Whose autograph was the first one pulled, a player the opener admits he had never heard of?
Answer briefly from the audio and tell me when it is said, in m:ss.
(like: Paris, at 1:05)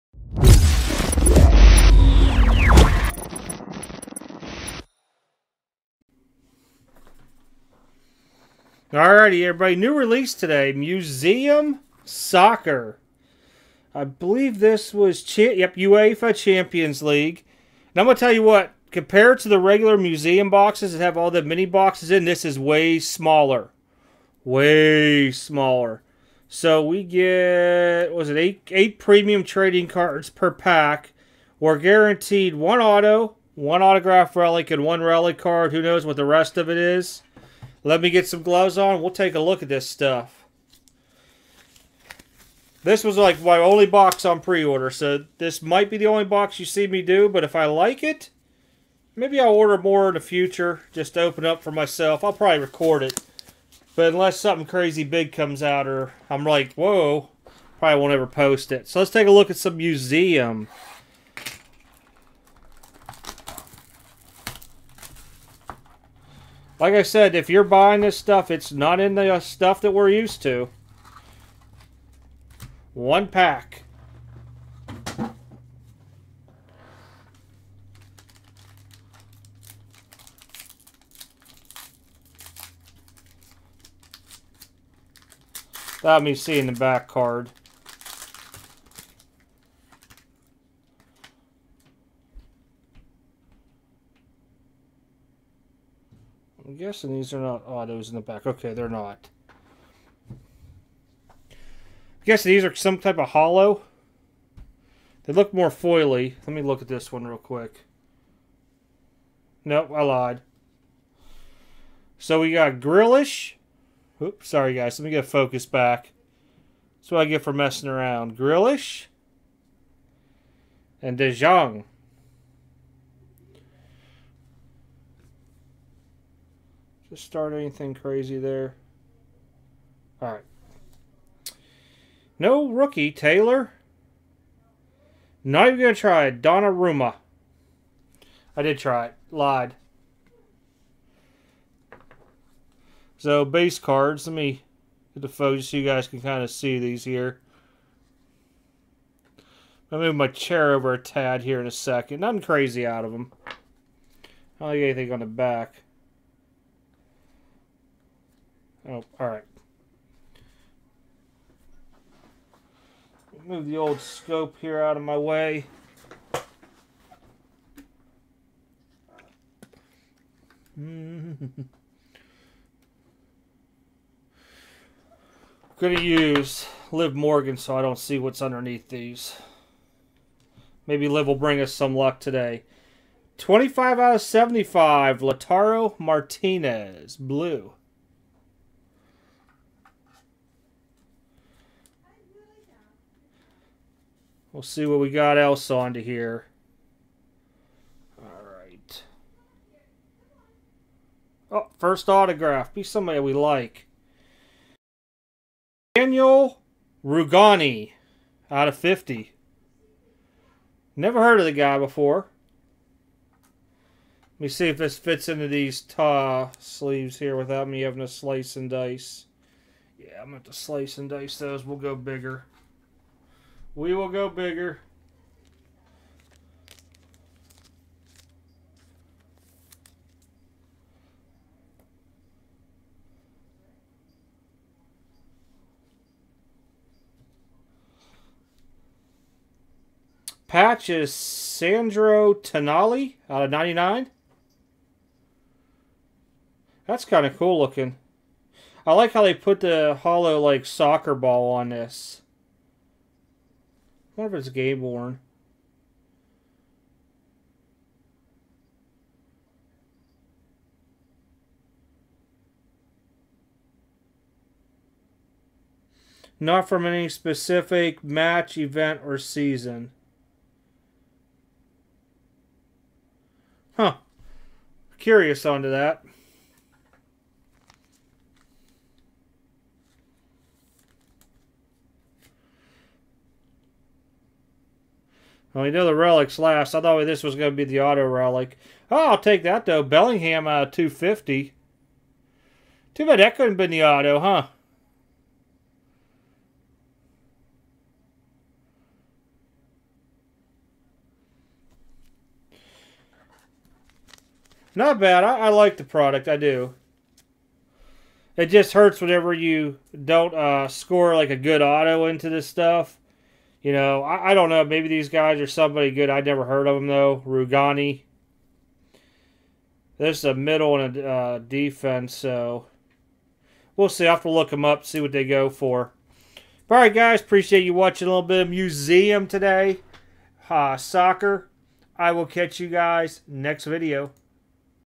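Daniel Rugani, at 3:25.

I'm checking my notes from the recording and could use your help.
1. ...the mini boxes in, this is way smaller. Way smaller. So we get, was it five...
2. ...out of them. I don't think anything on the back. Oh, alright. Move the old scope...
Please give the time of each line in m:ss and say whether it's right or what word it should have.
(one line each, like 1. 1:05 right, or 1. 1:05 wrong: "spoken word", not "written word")
1. 0:21 wrong: "eight", not "five"
2. 2:32 right.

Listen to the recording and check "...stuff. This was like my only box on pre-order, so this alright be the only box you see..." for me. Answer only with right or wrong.
wrong.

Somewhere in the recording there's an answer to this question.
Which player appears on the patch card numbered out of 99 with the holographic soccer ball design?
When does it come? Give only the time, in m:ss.
4:01.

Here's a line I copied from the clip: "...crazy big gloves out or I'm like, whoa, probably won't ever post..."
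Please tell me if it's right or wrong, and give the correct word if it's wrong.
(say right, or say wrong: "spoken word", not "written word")
wrong: "comes", not "gloves".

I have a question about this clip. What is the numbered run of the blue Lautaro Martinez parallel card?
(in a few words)
75.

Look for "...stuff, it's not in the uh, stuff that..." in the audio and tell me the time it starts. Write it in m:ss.
1:08.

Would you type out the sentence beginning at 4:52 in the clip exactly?
Too bad that couldn't have been the auto, huh?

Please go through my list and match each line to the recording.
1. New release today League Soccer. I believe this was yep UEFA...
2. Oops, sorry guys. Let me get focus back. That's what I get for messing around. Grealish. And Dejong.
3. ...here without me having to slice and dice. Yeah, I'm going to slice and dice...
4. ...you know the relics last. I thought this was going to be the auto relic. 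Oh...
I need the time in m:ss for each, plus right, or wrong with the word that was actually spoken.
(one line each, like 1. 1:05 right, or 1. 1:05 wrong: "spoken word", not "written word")
1. 0:09 wrong: "Museum", not "League"
2. 1:54 right
3. 3:37 right
4. 4:45 right.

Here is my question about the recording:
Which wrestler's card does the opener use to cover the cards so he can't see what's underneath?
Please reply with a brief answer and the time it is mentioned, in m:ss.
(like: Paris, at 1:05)
Liv Morgan, at 2:56.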